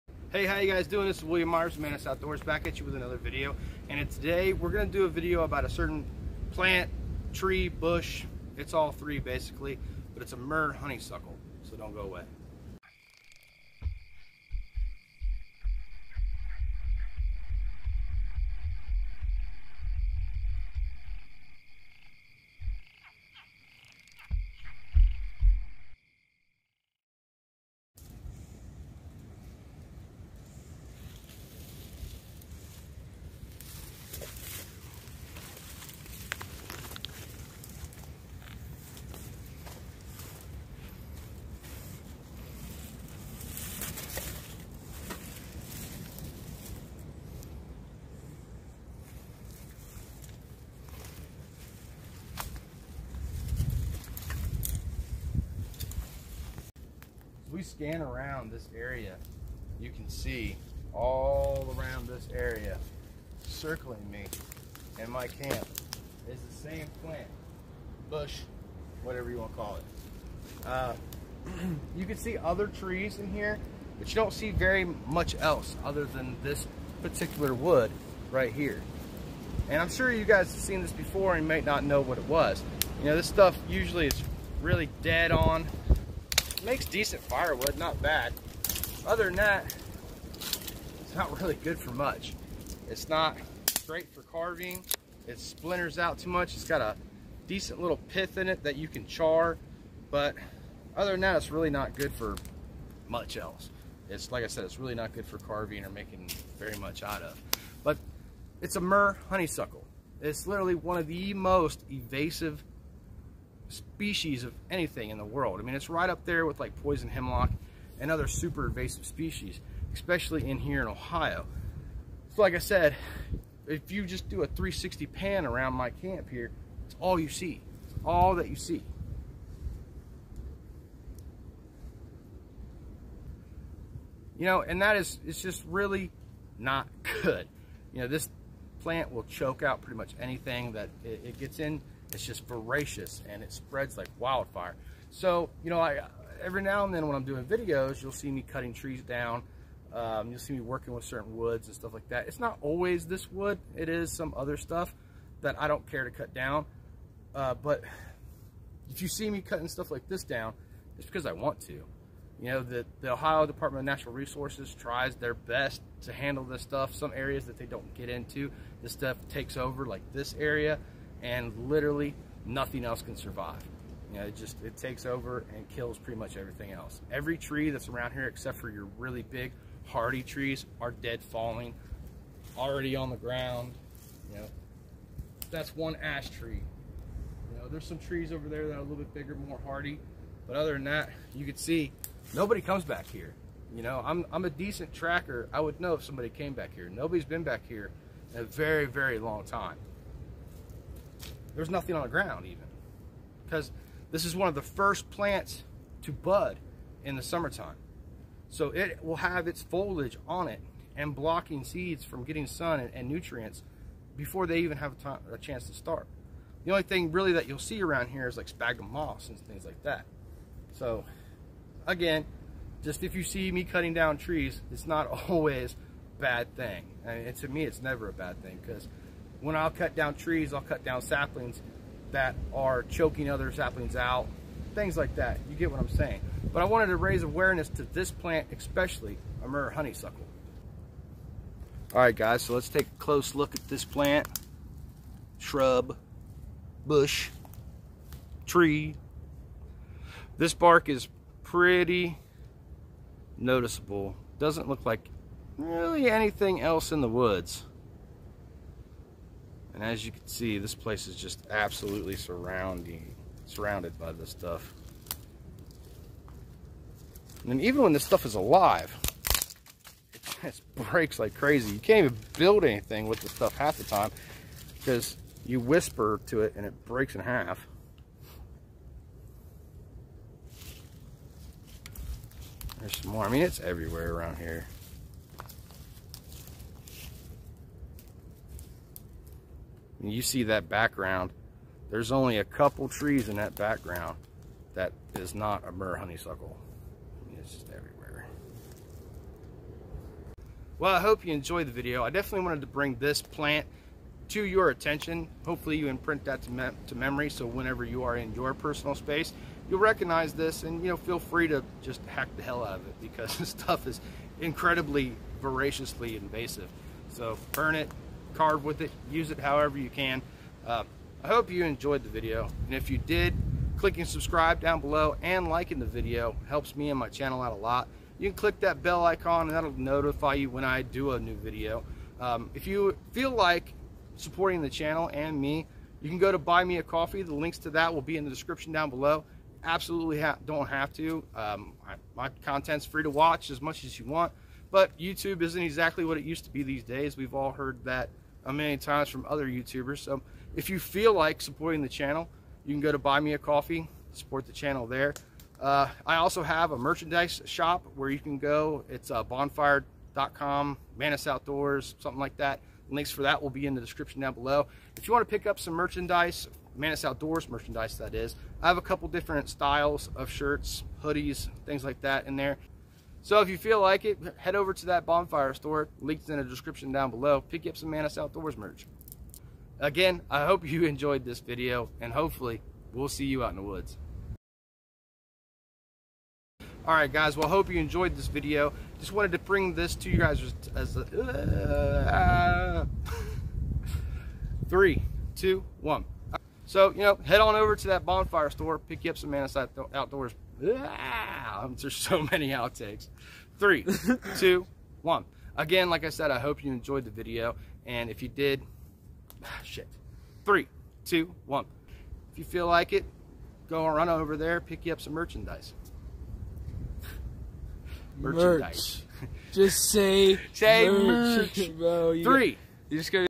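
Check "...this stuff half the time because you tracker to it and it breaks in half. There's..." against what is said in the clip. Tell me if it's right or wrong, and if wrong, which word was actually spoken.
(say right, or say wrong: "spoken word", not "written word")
wrong: "whisper", not "tracker".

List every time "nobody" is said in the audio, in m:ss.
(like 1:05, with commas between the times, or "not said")
3:12, 3:16.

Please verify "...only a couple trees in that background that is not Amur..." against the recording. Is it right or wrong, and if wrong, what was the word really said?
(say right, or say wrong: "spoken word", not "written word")
right.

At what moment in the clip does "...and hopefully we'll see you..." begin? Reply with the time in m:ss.
6:21.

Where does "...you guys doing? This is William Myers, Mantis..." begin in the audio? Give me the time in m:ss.
0:00.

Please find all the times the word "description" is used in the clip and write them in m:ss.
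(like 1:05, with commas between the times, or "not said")
5:38, 6:03, 6:16.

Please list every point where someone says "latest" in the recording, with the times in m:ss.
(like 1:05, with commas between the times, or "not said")
not said.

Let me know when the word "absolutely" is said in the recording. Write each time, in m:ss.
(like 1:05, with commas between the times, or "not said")
4:21, 5:39.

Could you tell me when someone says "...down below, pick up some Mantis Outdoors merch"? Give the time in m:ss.
6:16.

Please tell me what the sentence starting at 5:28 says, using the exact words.
You can click that bell icon and that'll notify you when I do a new video.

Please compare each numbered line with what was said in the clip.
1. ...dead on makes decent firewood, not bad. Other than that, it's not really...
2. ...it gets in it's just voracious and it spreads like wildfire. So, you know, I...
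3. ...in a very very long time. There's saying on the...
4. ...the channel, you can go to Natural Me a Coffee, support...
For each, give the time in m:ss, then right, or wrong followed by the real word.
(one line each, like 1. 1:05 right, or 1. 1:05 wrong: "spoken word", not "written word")
1. 1:25 right
2. 2:21 right
3. 3:18 wrong: "nothing", not "saying"
4. 5:51 wrong: "Buy", not "Natural".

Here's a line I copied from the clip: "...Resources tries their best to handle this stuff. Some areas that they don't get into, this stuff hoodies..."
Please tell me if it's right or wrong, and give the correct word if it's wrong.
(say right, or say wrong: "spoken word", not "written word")
wrong: "takes", not "hoodies".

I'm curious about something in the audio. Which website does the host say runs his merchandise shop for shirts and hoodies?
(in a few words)
bonfire.com.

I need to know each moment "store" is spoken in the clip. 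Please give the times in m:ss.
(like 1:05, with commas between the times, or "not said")
6:15, 6:38.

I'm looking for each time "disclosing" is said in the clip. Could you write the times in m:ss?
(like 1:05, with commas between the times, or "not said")
not said.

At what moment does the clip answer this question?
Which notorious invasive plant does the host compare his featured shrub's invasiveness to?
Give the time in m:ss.
1:56.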